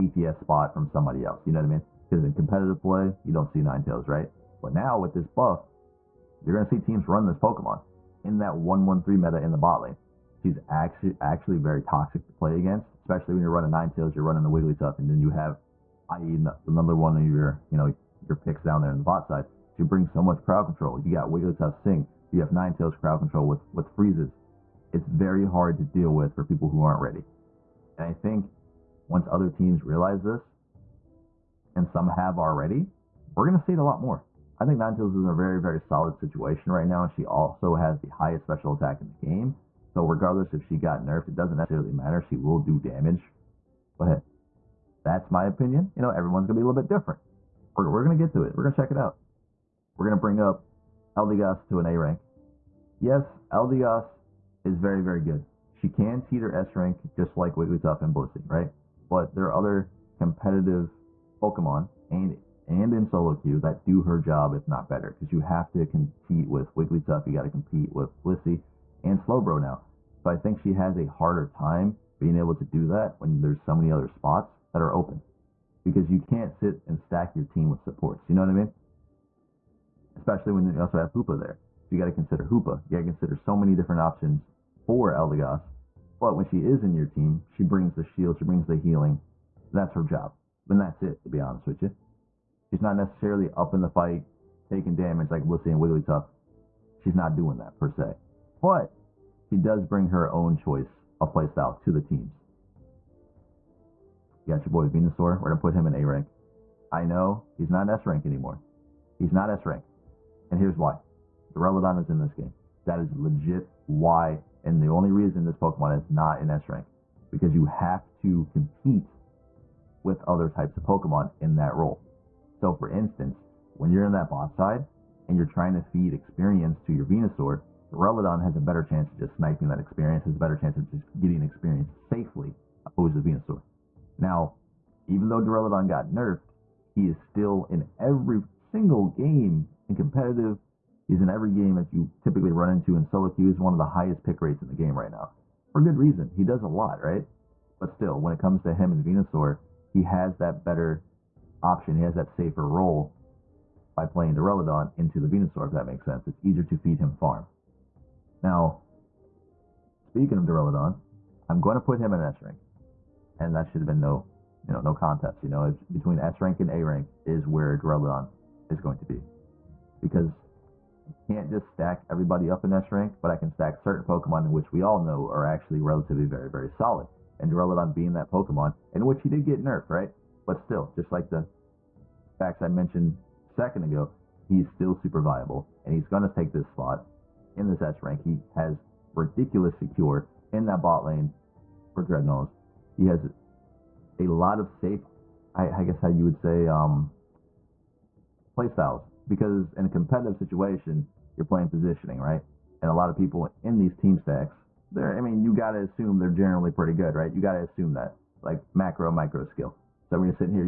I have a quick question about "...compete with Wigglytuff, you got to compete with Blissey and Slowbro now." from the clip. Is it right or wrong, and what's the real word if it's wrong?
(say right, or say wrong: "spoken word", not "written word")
right.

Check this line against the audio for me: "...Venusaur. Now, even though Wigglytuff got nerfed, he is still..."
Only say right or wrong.
wrong.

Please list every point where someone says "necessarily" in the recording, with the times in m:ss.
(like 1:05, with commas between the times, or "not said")
0:41, 1:32.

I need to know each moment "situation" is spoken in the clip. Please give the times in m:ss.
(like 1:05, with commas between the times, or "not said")
0:36, 3:20.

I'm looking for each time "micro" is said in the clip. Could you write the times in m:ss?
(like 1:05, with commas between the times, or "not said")
3:29.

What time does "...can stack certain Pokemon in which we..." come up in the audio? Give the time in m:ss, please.
2:53.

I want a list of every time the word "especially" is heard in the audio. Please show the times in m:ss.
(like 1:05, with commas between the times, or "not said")
0:12, 1:20.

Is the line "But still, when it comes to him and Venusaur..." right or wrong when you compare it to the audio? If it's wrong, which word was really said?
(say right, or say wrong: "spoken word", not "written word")
right.